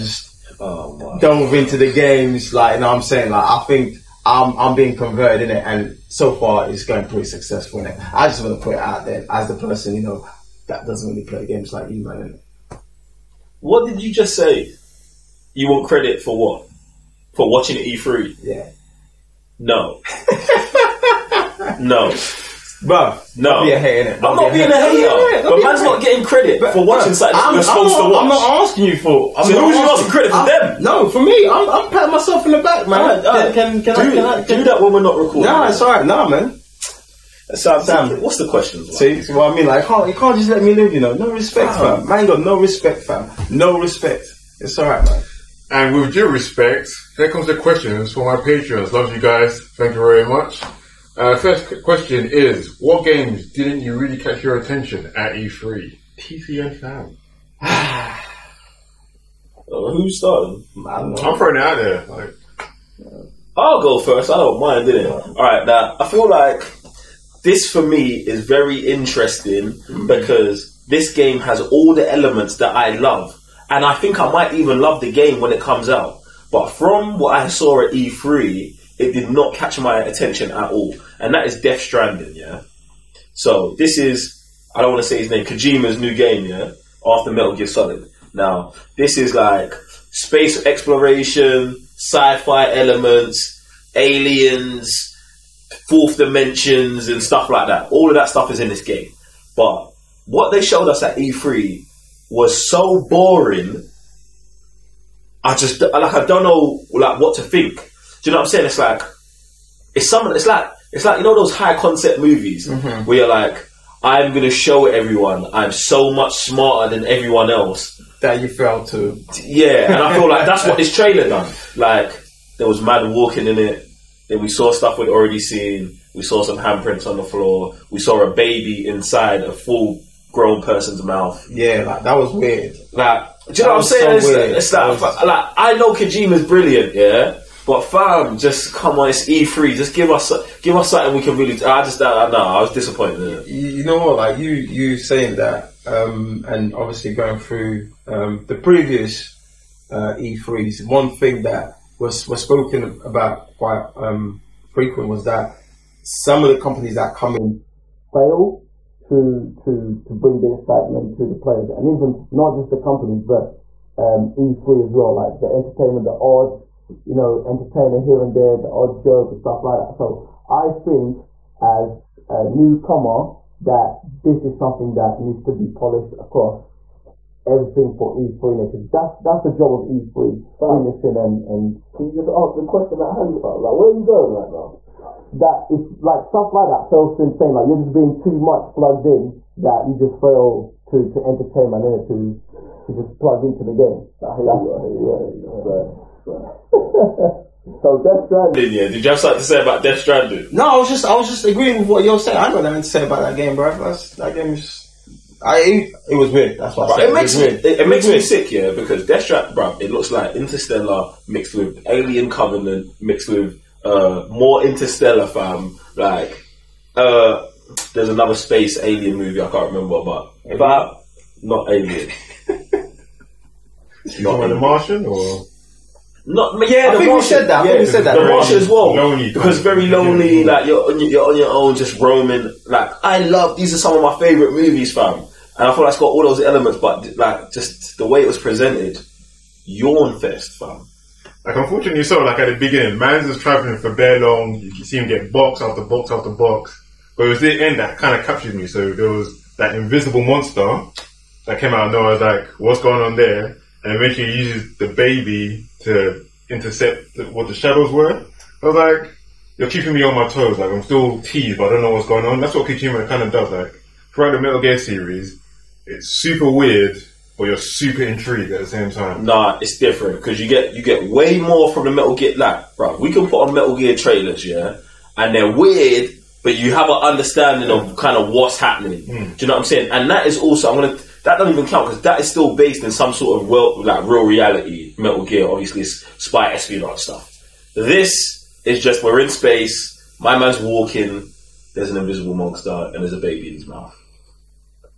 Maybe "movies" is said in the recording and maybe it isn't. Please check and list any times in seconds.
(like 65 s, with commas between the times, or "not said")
112 s, 219 s, 234 s.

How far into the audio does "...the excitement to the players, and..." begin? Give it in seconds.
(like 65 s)
160 s.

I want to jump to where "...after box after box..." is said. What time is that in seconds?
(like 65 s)
245 s.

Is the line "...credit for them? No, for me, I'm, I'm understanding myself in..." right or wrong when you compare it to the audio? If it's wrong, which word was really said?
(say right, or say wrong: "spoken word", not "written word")
wrong: "patting", not "understanding".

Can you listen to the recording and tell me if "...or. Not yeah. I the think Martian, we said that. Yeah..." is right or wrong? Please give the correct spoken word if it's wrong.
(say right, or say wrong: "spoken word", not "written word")
right.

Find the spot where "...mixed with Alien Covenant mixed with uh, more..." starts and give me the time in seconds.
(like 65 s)
211 s.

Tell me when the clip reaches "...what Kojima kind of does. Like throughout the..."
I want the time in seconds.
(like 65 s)
262 s.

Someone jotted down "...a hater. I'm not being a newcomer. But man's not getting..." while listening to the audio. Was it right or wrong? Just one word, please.
wrong.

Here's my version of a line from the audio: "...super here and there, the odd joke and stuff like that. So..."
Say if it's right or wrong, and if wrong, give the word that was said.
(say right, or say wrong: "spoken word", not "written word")
wrong: "entertainer", not "super".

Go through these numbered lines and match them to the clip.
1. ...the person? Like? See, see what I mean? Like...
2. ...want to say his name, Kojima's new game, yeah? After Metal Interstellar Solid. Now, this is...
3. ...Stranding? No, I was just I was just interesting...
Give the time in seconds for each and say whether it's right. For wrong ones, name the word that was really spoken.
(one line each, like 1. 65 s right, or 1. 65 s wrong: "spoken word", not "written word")
1. 38 s wrong: "question", not "person"
2. 84 s wrong: "Gear", not "Interstellar"
3. 199 s wrong: "agreeing", not "interesting".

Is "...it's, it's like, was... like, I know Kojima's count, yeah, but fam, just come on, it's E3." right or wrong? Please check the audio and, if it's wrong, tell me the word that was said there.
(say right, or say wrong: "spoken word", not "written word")
wrong: "brilliant", not "count".